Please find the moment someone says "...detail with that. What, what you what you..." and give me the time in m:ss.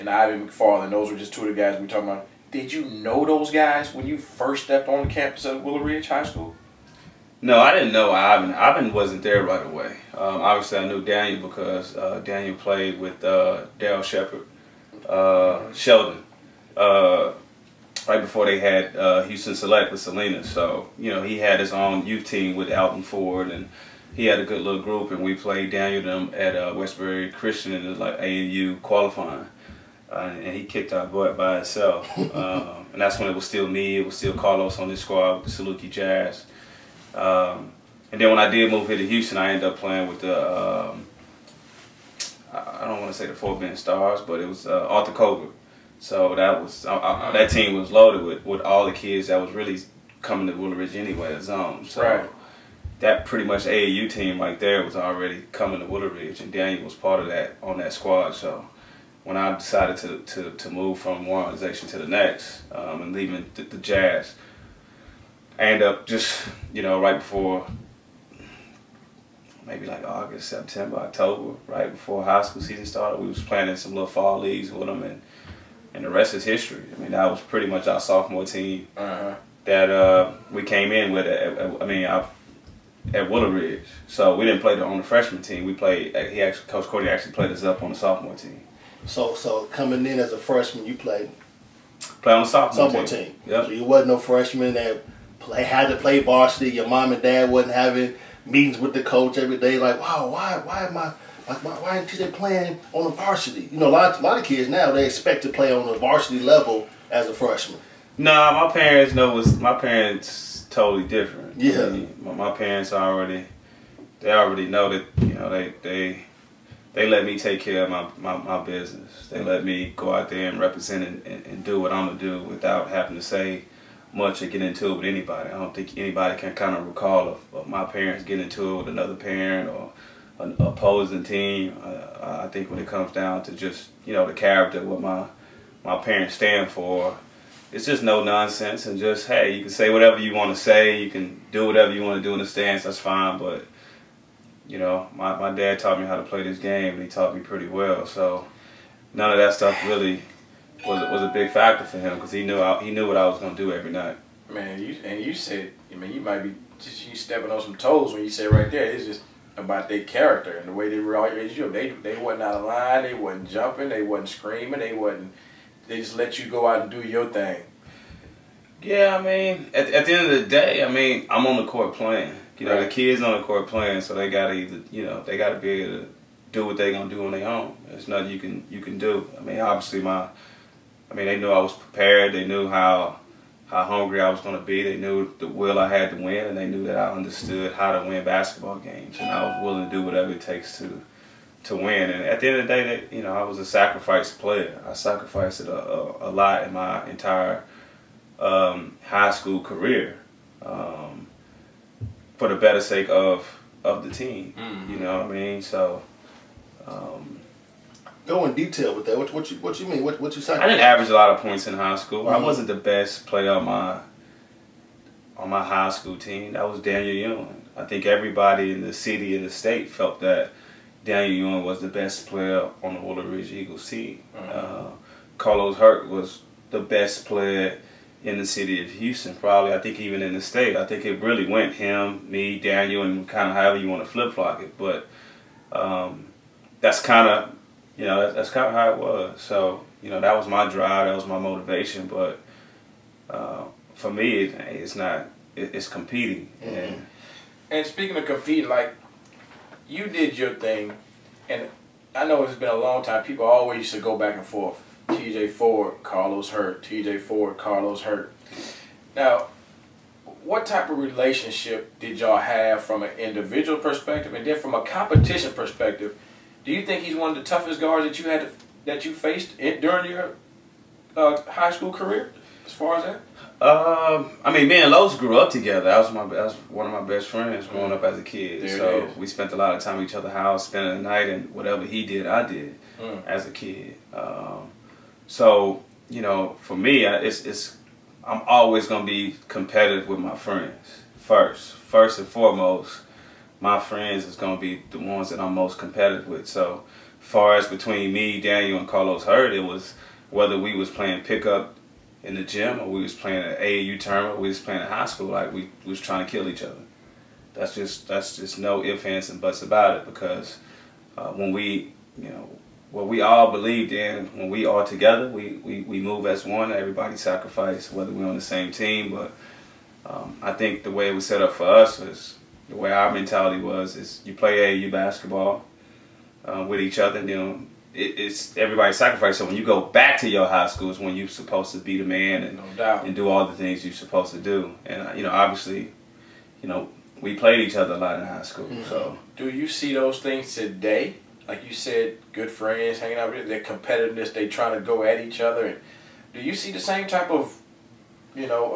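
3:28.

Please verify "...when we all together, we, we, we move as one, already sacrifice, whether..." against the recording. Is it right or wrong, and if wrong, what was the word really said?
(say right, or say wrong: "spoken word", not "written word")
wrong: "everybody", not "already".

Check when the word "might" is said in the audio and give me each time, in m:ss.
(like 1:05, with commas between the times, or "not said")
2:36.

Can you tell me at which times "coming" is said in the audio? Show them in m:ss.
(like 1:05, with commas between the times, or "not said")
0:50, 0:55, 1:29.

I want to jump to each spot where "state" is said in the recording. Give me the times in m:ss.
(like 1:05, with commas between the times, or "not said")
3:39, 3:50.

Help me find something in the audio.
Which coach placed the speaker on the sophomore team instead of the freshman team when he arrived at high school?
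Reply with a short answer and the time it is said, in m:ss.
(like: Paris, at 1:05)
Coach Cody, at 1:26.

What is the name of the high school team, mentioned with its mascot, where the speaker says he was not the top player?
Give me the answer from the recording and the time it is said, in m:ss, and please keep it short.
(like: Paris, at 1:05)
Willow Ridge Eagles, at 3:42.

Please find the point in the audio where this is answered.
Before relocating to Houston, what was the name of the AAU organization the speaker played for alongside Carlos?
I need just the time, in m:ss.
0:35.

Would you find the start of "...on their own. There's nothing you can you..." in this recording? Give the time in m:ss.
2:57.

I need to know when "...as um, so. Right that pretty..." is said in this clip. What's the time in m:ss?
0:51.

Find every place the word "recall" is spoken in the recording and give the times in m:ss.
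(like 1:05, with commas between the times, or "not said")
2:06.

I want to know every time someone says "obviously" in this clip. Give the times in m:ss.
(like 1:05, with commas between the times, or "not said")
0:10, 2:59, 5:35.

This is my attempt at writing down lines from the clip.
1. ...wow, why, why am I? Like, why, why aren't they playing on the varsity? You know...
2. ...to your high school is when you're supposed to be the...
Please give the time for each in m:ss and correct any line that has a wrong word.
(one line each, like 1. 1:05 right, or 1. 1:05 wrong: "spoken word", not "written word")
1. 1:39 right
2. 5:30 right.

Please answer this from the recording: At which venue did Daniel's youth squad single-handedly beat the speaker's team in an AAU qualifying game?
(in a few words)
Westbury Christian.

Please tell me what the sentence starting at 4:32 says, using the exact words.
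As far as that, uh, I mean, me and Los grew up together.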